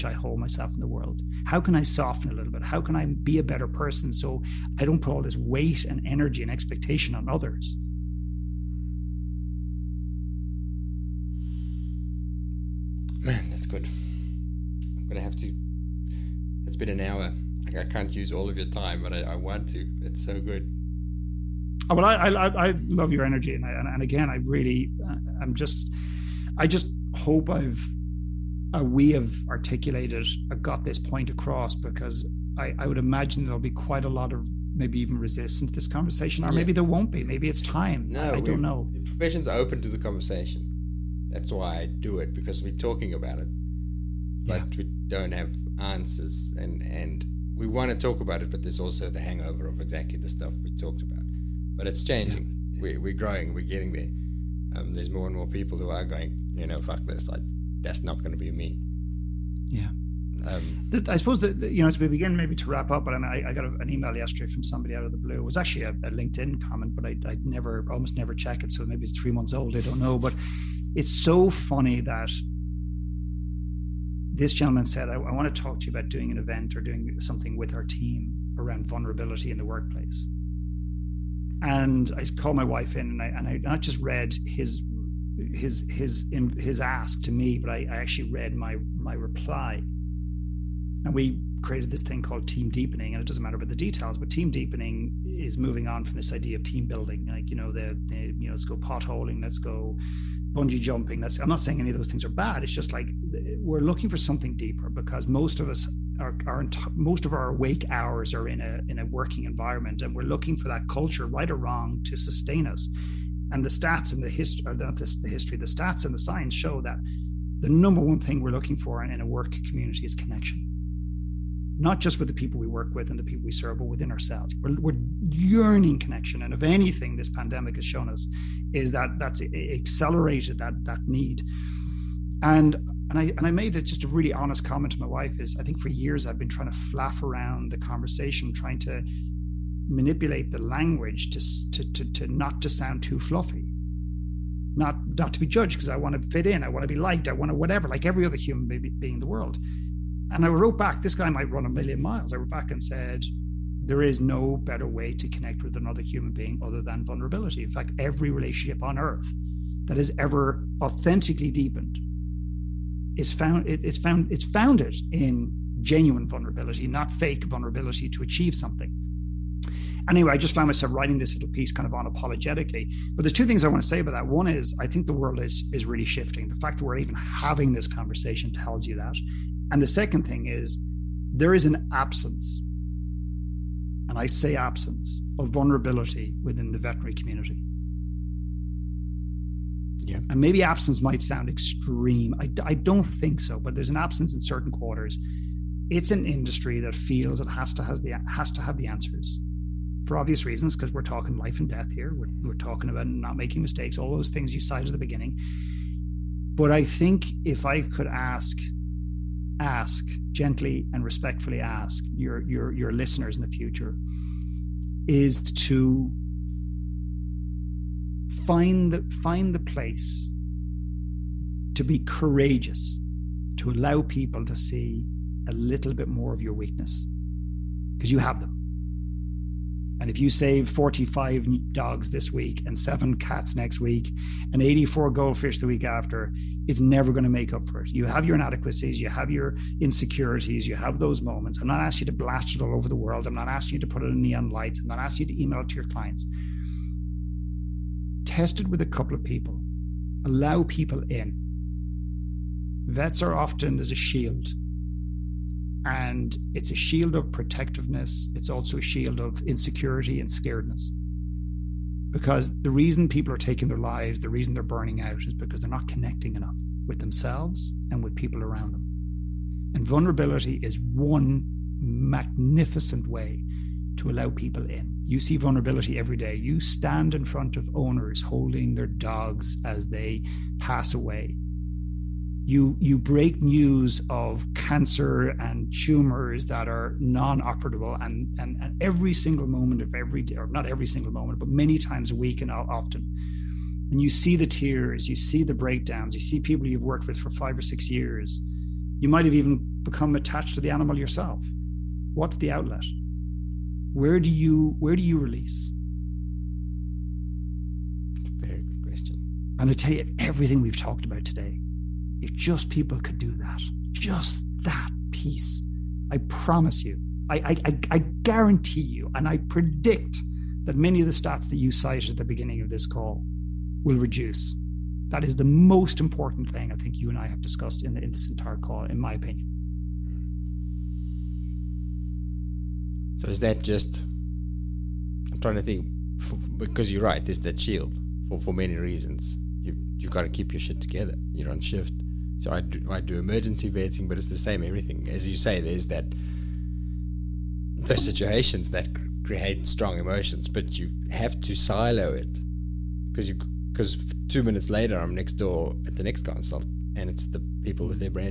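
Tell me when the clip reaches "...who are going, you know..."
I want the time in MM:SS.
00:55.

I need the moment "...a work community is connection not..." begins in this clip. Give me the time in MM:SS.
01:59.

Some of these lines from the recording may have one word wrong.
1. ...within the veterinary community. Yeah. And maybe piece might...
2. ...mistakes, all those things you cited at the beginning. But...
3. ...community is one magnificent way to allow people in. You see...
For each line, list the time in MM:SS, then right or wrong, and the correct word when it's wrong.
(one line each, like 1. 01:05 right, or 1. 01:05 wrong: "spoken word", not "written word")
1. 03:06 wrong: "absence", not "piece"
2. 03:23 right
3. 04:29 wrong: "vulnerability", not "community".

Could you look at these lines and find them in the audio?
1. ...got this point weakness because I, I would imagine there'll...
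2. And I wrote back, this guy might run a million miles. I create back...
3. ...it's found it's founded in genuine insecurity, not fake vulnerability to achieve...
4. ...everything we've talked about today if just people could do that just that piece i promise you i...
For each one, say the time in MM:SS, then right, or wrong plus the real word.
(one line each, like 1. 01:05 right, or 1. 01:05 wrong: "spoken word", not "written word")
1. 00:30 wrong: "across", not "weakness"
2. 02:30 wrong: "wrote", not "create"
3. 02:43 wrong: "vulnerability", not "insecurity"
4. 05:10 right.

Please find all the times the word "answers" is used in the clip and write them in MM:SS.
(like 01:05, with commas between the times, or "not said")
00:45, 03:18.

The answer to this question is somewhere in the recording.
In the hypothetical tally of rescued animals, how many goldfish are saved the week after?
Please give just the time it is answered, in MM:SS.
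03:54.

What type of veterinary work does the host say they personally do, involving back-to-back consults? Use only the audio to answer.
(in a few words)
emergency vetting.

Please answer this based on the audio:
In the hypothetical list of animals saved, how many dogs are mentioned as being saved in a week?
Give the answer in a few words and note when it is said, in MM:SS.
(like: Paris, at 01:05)
45, at 03:50.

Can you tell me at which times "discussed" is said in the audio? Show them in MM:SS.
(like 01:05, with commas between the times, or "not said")
05:27.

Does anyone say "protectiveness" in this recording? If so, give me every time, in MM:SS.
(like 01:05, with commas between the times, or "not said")
04:17.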